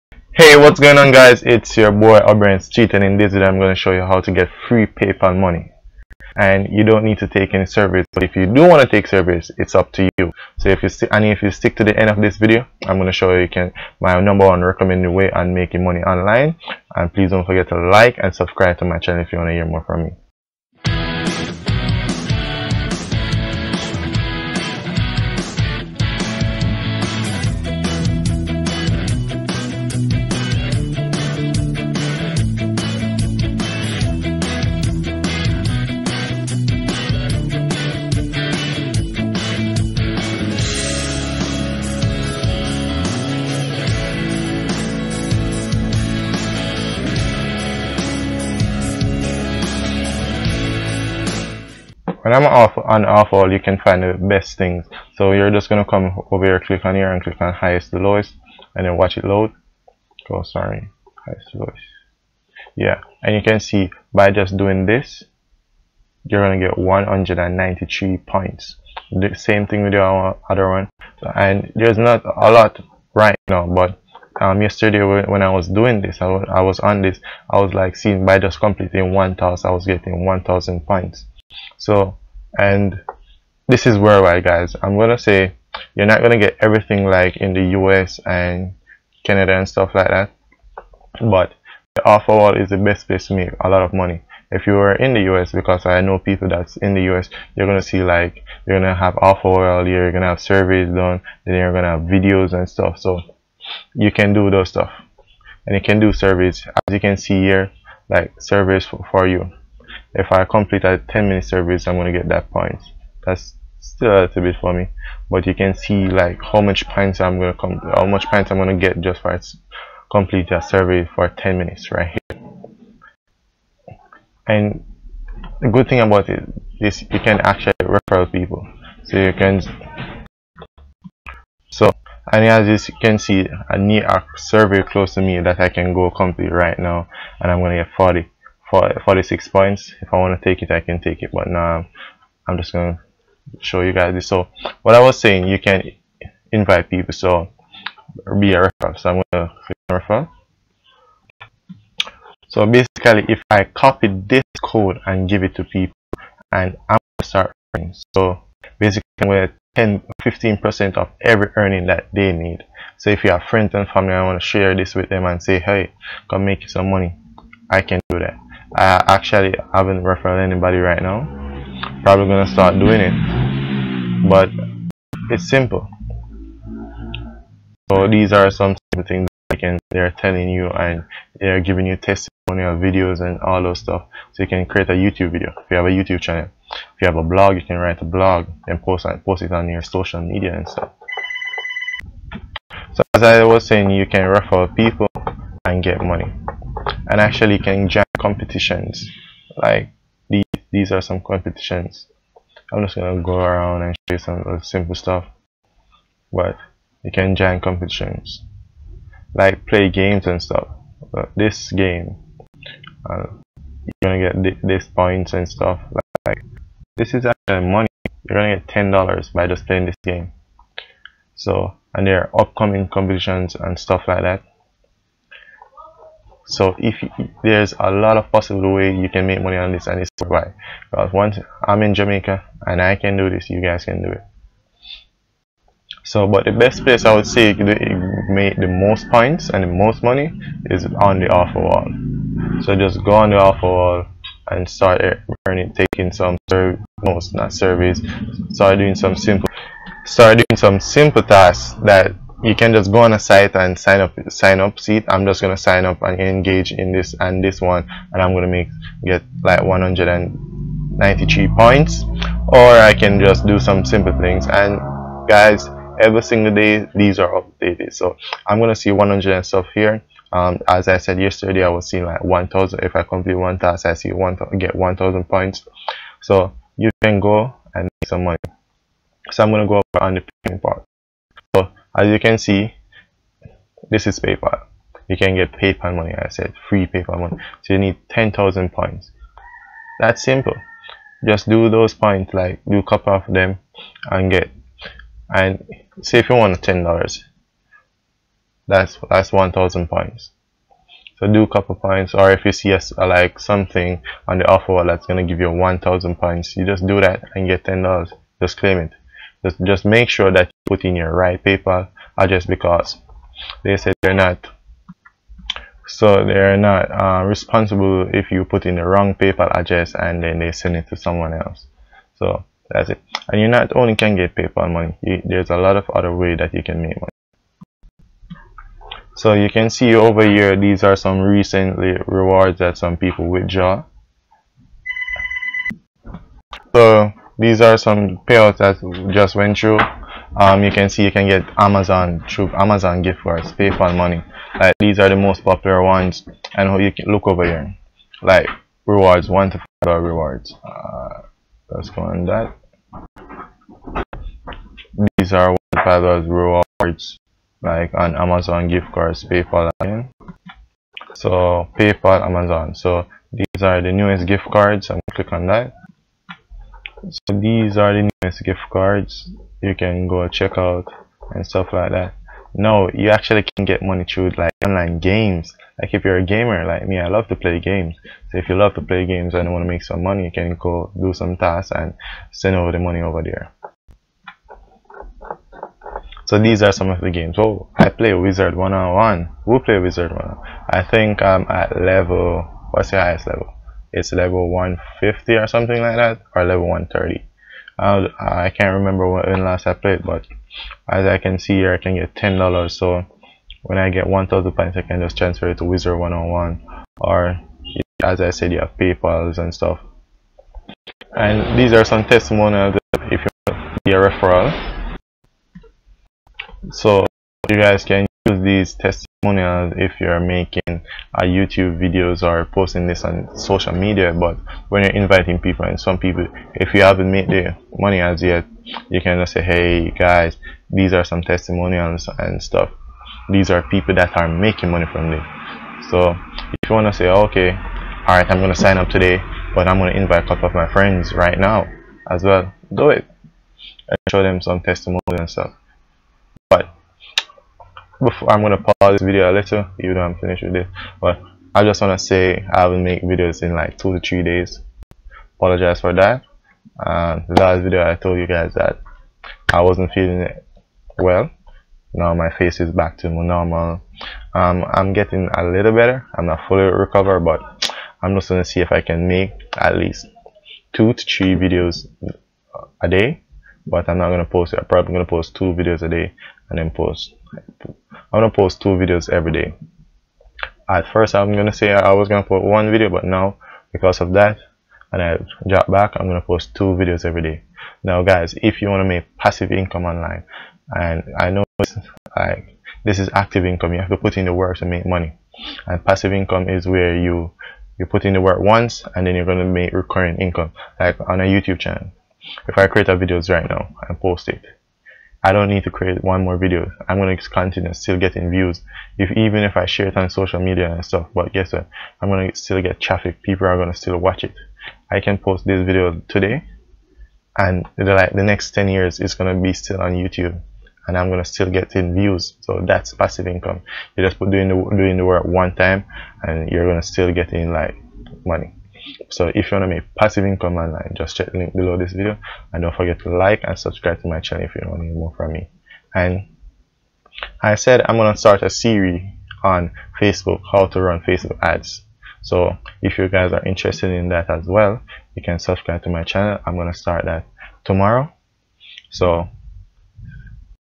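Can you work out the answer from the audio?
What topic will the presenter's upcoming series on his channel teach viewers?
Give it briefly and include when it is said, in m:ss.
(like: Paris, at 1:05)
how to run Facebook ads, at 9:00.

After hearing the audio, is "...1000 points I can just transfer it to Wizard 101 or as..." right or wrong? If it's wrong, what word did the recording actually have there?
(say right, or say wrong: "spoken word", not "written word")
right.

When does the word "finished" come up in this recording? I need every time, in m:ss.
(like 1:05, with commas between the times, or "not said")
7:30.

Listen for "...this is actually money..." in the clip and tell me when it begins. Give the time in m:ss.
3:36.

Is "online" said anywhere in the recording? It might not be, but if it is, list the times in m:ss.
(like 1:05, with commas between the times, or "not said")
0:15, 6:14, 8:09, 8:50.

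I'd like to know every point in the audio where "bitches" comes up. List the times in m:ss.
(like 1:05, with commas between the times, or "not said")
not said.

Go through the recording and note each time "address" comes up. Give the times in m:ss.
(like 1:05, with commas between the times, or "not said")
5:12, 5:19.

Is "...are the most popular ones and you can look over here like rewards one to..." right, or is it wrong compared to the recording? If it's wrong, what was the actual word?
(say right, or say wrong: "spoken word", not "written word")
right.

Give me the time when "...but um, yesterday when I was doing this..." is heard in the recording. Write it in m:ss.
1:13.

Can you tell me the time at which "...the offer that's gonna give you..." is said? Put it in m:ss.
5:04.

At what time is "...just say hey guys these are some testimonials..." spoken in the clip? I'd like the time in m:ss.
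7:09.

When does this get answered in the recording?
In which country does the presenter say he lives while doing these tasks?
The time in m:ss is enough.
3:51.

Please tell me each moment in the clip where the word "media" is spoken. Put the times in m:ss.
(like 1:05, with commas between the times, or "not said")
3:10, 7:03, 8:30.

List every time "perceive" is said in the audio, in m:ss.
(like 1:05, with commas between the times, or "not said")
not said.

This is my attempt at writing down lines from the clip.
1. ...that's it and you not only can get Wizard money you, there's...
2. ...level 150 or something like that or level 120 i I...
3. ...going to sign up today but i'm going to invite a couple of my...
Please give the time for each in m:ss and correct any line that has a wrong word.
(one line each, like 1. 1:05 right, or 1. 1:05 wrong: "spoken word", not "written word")
1. 5:22 wrong: "PayPal", not "Wizard"
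2. 6:34 wrong: "130", not "120"
3. 7:18 right.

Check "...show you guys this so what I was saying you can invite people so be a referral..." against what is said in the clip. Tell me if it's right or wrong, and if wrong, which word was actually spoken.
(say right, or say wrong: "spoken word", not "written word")
right.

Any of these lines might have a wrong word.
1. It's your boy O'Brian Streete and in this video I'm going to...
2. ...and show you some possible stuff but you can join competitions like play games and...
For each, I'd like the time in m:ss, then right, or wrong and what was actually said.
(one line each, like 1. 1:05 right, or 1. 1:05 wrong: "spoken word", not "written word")
1. 0:01 right
2. 3:23 wrong: "simple", not "possible".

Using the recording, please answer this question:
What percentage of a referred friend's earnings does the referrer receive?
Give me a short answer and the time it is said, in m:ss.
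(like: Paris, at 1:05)
15%, at 2:40.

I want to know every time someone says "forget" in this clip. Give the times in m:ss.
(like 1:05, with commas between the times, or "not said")
0:17, 8:52.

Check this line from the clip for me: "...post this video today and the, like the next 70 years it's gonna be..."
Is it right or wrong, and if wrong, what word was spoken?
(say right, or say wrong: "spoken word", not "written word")
wrong: "10", not "70".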